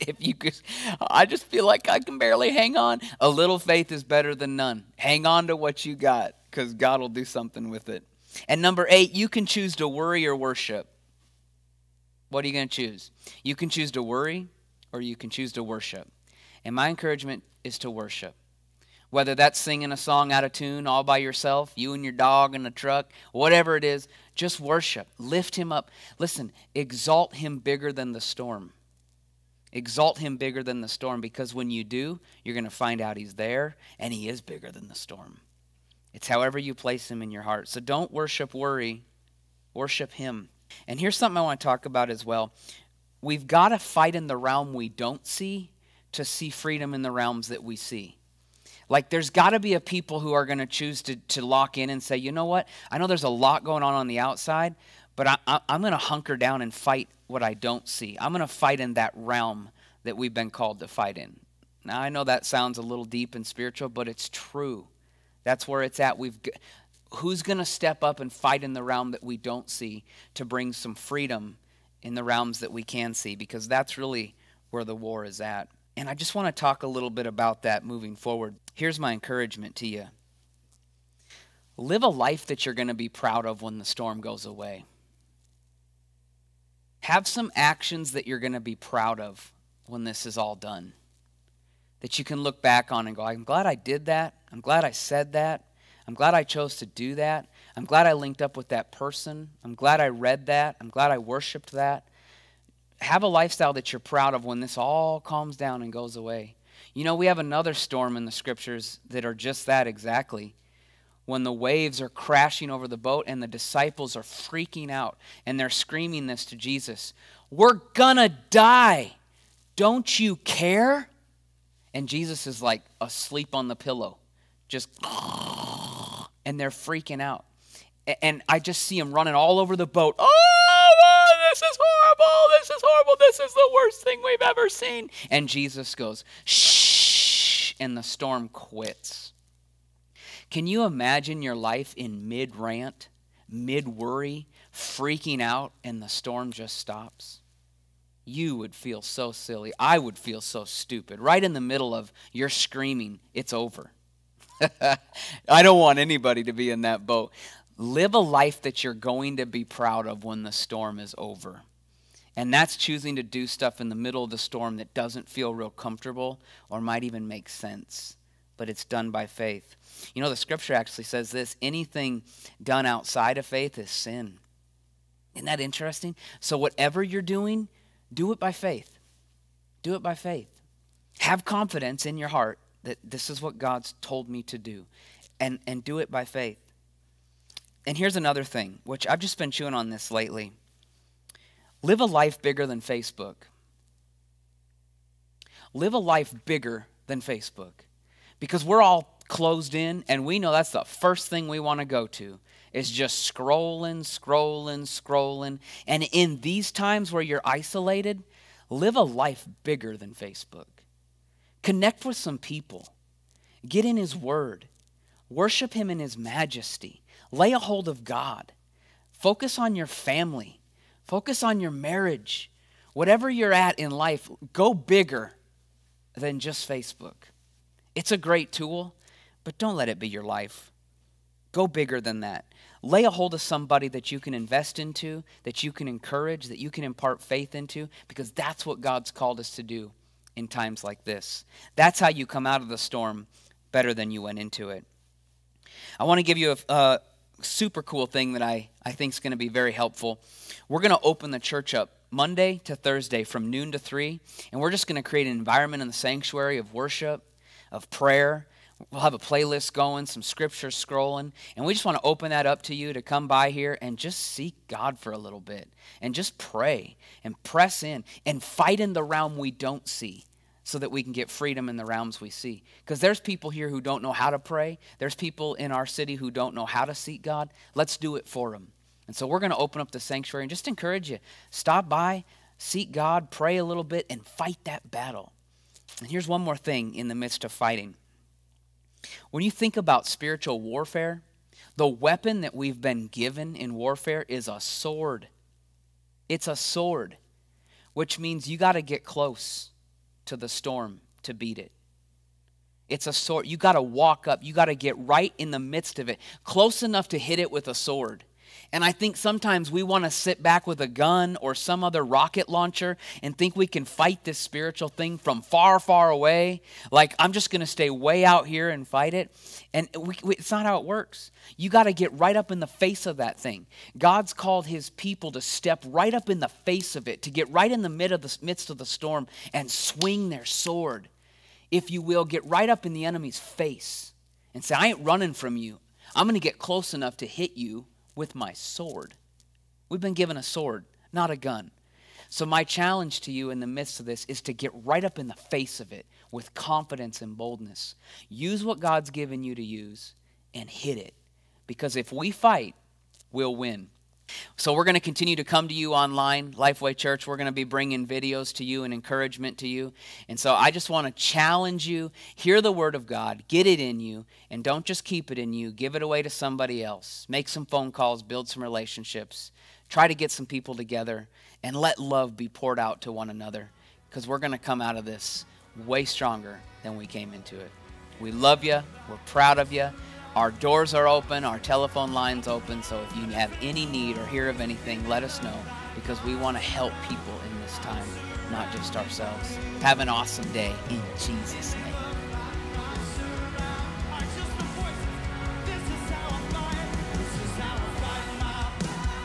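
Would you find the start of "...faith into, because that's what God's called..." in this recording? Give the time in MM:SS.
03:57.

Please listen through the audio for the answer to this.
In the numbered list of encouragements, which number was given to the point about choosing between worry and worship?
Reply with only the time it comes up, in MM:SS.
00:08.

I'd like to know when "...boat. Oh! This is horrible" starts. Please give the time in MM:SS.
02:09.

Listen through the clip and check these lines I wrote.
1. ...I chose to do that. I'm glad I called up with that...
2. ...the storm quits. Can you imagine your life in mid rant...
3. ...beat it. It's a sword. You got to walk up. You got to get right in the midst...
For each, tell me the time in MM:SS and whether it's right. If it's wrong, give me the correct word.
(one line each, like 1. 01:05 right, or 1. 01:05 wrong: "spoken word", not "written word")
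1. 01:36 wrong: "linked", not "called"
2. 02:17 right
3. 05:01 right.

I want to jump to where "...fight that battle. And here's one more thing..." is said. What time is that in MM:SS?
04:44.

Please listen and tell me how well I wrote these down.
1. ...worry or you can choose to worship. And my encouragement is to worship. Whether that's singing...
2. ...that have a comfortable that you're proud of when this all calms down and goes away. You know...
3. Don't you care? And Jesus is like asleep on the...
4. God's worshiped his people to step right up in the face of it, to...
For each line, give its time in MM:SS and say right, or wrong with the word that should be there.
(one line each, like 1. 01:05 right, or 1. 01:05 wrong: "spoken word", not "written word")
1. 00:14 right
2. 01:41 wrong: "lifestyle", not "comfortable"
3. 01:59 right
4. 05:23 wrong: "called", not "worshiped".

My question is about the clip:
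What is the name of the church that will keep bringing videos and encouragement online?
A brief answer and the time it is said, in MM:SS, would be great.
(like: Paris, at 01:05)
Lifeway Church, at 05:56.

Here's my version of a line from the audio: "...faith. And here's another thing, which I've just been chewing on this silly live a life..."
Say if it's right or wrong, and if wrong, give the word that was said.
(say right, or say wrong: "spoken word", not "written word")
wrong: "lately", not "silly".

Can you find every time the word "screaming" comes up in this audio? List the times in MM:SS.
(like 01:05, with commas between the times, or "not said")
01:55, 02:32.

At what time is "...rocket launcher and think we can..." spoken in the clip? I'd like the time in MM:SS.
05:12.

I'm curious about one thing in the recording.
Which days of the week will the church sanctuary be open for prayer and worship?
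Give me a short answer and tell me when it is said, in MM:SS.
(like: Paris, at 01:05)
Monday to Thursday, at 04:12.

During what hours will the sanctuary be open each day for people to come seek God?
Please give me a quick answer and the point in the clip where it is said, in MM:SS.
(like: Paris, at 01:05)
Noon to 3, at 04:13.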